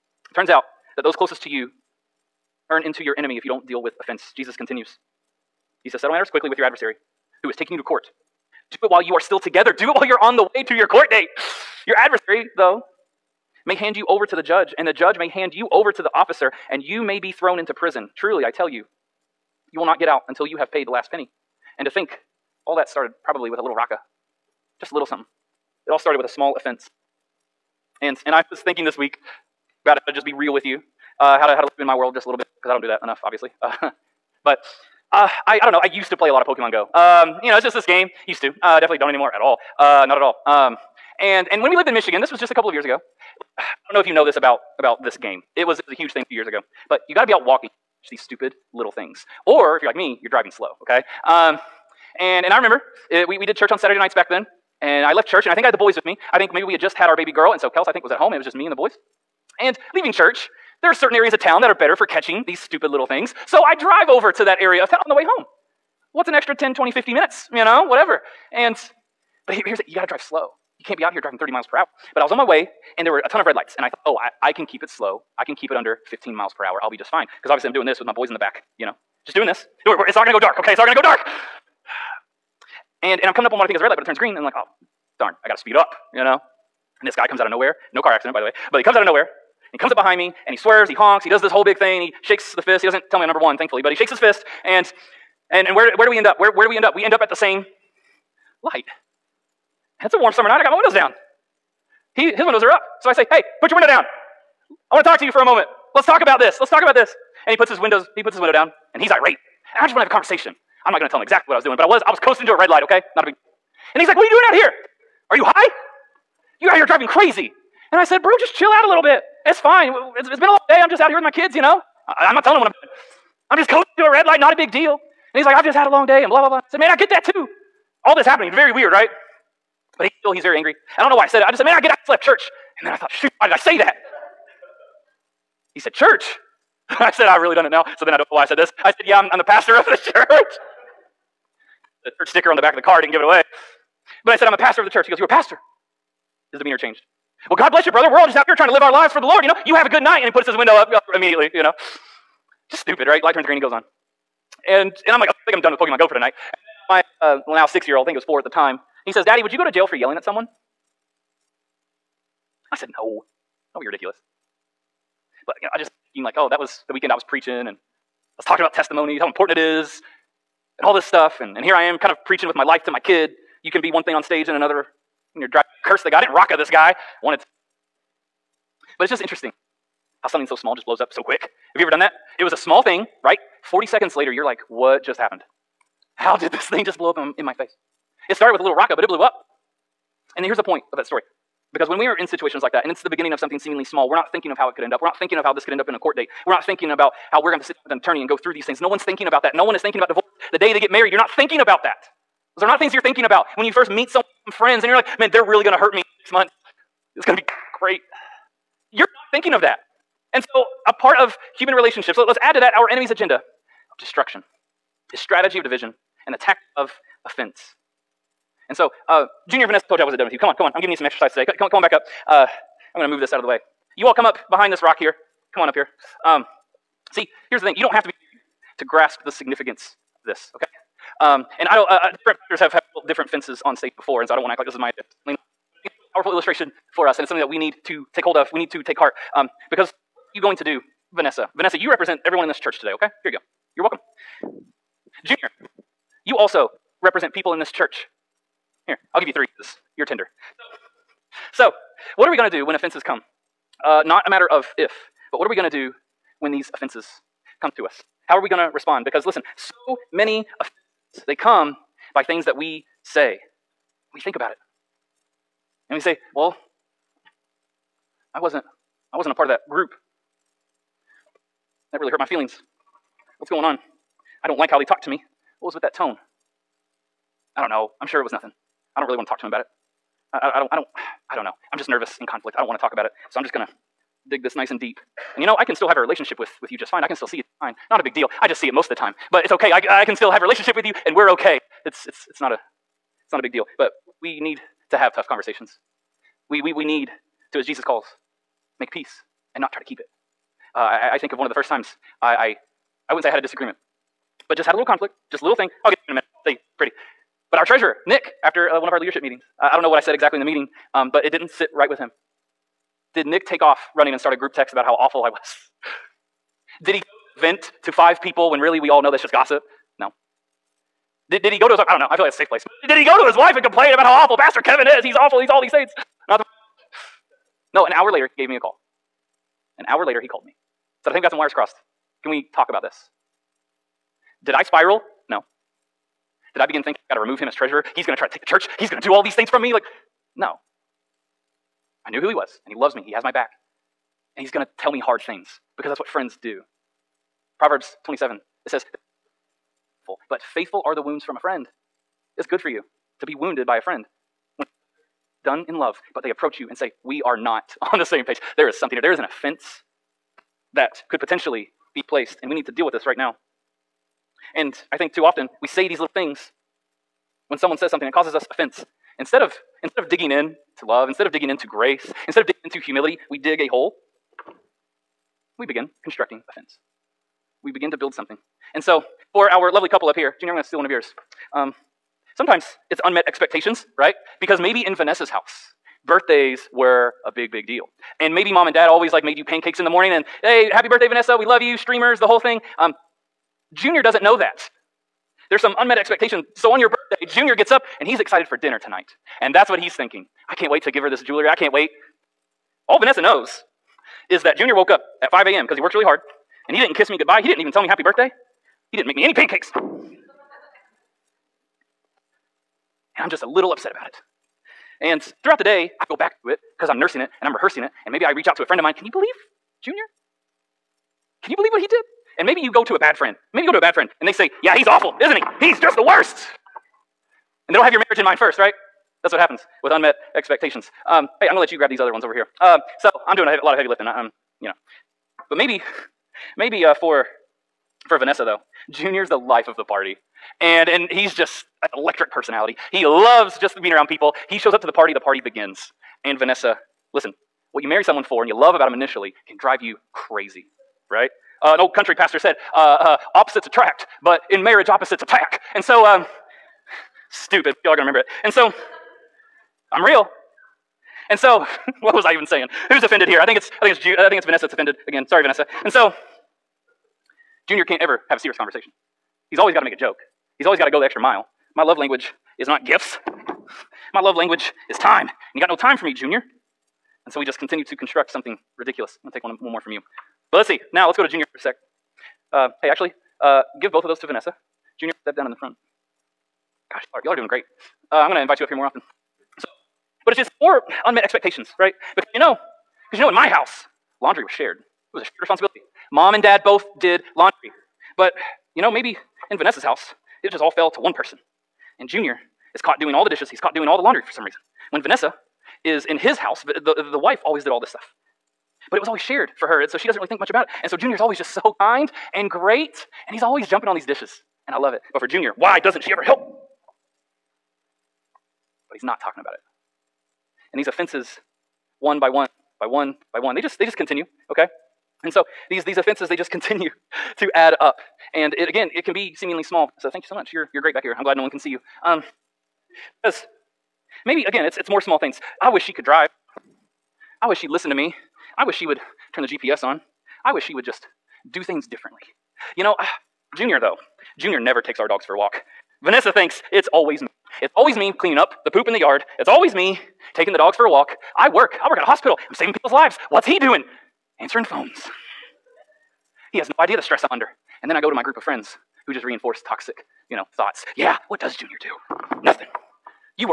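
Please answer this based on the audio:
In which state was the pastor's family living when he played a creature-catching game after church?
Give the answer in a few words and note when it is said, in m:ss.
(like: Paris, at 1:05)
Michigan, at 0:41.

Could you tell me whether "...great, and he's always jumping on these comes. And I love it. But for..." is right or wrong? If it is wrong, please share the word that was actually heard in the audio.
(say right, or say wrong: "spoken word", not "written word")
wrong: "dishes", not "comes".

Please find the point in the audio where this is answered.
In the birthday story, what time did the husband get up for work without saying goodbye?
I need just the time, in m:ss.
6:45.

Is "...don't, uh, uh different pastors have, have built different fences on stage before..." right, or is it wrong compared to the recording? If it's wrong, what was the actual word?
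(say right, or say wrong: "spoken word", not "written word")
right.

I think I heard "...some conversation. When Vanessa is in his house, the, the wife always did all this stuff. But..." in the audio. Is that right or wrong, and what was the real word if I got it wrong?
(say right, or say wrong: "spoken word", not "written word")
wrong: "reason", not "conversation".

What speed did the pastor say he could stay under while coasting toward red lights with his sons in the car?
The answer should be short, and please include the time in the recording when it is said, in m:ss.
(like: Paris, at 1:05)
15 miles per hour, at 1:16.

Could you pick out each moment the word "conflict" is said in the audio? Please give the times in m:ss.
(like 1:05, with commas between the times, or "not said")
4:42, 5:04.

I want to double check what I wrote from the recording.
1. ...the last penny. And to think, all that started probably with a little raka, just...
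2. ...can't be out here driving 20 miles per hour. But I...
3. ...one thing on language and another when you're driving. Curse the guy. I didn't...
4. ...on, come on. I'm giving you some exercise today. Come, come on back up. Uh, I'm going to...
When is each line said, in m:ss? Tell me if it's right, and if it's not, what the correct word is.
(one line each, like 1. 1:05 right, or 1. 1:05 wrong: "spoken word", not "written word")
1. 0:20 right
2. 1:10 wrong: "30", not "20"
3. 2:53 wrong: "stage", not "language"
4. 3:40 right.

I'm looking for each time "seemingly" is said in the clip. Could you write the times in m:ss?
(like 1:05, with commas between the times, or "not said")
3:13, 8:49.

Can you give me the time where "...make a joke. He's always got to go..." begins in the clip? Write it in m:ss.
7:49.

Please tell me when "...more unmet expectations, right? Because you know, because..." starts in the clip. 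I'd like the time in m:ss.
8:10.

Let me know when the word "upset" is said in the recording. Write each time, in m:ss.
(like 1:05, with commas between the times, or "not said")
6:53.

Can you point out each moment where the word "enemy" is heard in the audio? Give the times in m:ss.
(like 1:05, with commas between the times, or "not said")
0:03, 3:32.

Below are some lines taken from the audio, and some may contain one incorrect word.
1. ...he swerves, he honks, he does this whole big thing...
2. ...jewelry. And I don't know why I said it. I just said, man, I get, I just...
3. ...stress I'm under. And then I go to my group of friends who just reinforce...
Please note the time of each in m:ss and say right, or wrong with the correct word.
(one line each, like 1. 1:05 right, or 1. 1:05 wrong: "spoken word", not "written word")
1. 1:30 right
2. 2:10 wrong: "angry", not "jewelry"
3. 9:17 right.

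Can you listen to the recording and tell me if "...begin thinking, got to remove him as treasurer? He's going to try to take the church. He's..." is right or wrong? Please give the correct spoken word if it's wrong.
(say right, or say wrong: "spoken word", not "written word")
right.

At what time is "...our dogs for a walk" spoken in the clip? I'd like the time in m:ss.
9:04.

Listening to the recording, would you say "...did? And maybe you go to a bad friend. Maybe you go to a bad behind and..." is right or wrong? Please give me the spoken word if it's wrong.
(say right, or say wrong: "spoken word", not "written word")
wrong: "friend", not "behind".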